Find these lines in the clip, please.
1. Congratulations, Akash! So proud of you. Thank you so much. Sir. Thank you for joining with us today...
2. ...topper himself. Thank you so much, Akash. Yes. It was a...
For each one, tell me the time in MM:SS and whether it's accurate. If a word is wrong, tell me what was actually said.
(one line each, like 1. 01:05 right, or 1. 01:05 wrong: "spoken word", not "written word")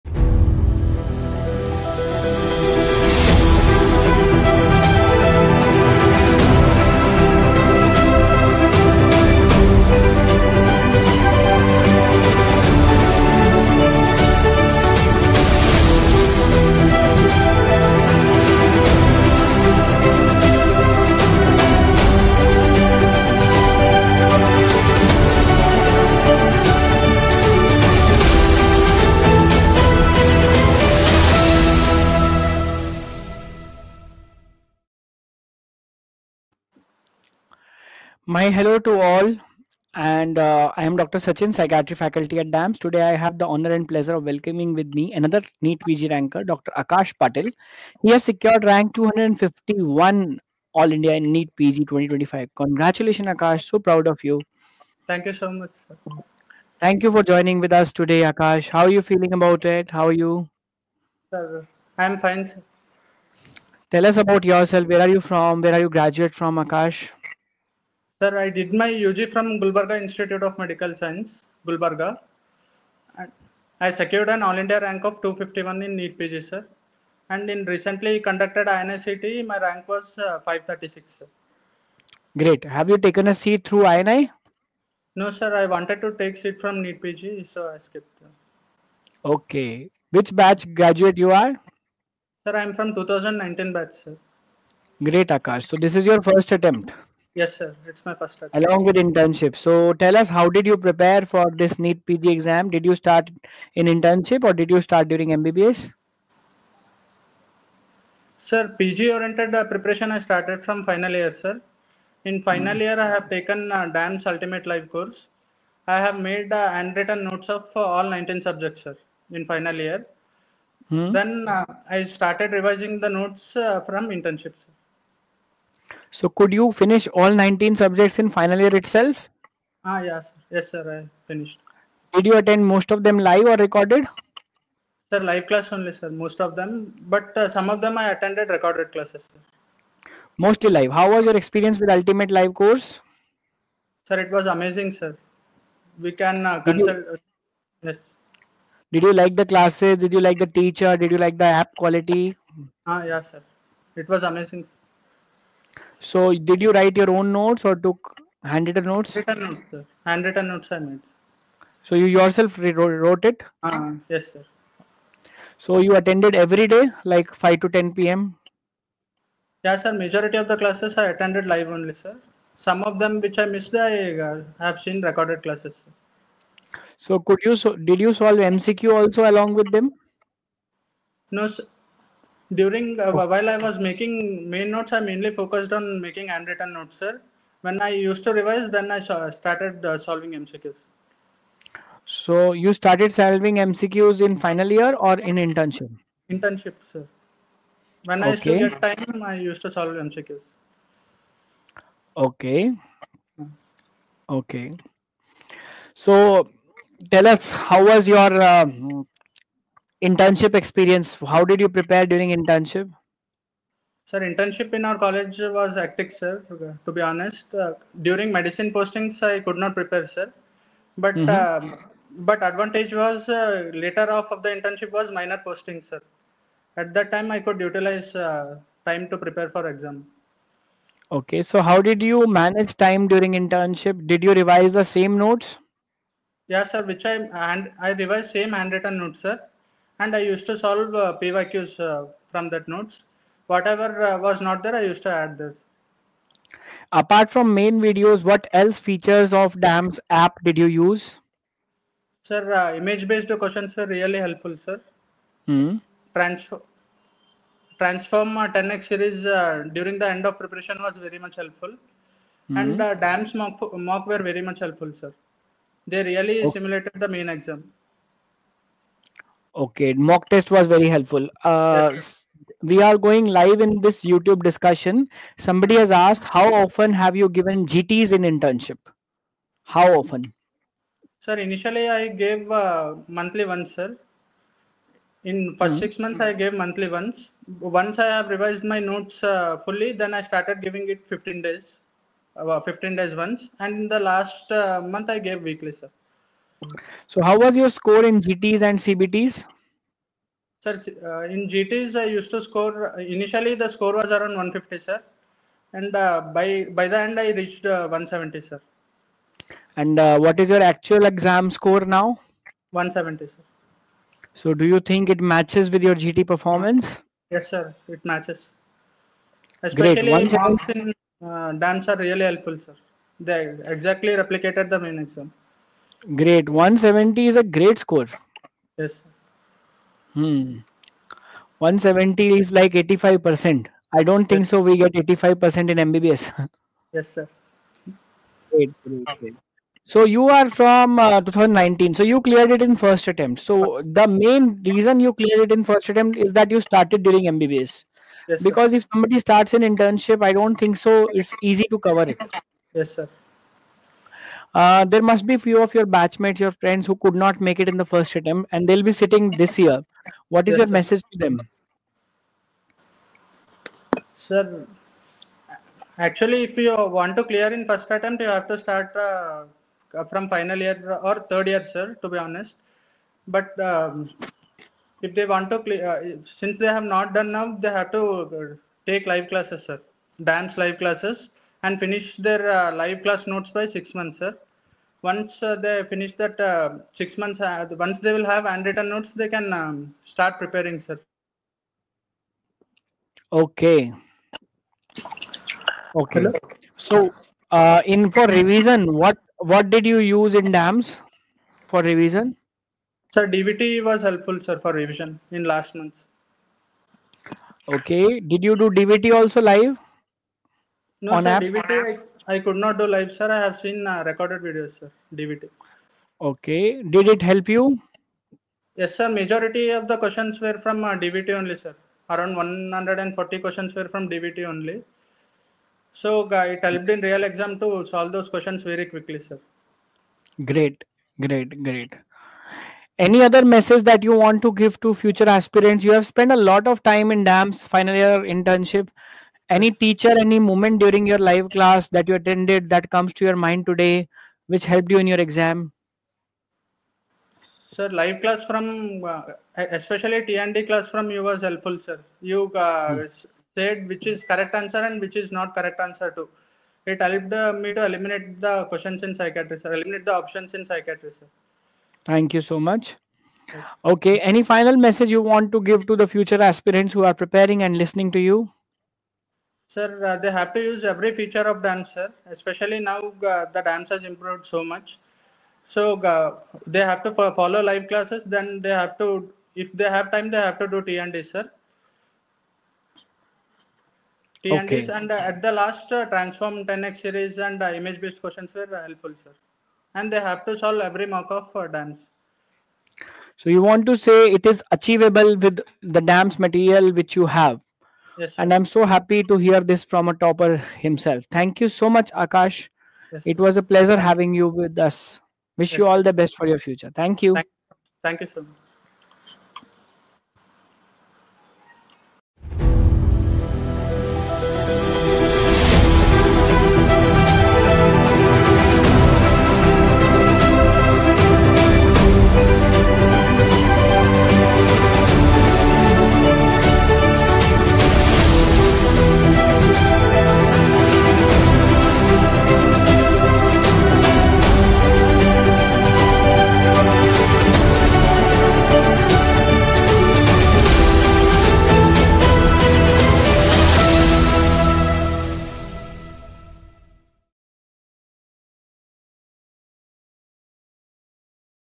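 1. 00:52 right
2. 08:20 right.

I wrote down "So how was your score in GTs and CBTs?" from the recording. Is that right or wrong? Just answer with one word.
right.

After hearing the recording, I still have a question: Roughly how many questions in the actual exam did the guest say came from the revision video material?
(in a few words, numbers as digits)
140.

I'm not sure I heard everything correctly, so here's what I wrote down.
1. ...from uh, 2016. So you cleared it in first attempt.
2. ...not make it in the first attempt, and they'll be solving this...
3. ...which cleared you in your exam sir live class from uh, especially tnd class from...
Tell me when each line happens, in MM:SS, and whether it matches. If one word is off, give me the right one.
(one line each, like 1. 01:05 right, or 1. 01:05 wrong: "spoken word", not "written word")
1. 05:40 wrong: "2019", not "2016"
2. 05:57 wrong: "sitting", not "solving"
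3. 07:24 wrong: "helped", not "cleared".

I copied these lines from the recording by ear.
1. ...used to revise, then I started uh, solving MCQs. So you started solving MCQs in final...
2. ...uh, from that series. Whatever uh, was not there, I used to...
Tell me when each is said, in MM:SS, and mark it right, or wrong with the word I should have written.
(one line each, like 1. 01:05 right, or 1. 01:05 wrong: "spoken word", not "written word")
1. 03:07 right
2. 04:01 wrong: "notes", not "series".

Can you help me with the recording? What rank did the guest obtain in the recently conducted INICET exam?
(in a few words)
536.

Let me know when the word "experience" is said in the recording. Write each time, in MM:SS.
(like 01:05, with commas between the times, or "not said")
02:21, 03:30.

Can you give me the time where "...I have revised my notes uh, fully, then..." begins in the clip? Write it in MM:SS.
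04:47.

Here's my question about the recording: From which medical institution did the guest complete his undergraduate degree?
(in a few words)
Gulbarga Institute of Medical Science.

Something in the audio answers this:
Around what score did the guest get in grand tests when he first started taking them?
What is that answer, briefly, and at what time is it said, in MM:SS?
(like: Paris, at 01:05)
150, at 05:04.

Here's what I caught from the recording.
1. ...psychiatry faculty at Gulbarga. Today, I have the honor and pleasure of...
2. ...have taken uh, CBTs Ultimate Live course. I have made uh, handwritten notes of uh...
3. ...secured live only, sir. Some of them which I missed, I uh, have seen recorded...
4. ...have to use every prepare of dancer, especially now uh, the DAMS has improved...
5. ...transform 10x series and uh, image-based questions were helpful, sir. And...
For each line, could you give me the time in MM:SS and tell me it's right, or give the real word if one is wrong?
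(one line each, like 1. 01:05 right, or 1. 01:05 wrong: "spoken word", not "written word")
1. 00:41 wrong: "DAMS", not "Gulbarga"
2. 01:53 wrong: "DAMS", not "CBTs"
3. 02:51 wrong: "attended", not "secured"
4. 07:50 wrong: "feature", not "prepare"
5. 08:06 right.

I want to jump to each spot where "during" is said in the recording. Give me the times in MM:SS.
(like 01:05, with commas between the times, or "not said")
01:45, 03:02, 03:32, 03:38, 03:53, 04:19, 05:47, 07:20.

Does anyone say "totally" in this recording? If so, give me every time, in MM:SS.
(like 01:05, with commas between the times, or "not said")
not said.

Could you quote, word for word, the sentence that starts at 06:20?
DAMS live classes and finish their uh, live class notes by six months, sir.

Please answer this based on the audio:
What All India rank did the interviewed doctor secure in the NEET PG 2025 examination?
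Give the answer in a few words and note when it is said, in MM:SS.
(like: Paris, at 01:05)
251, at 00:48.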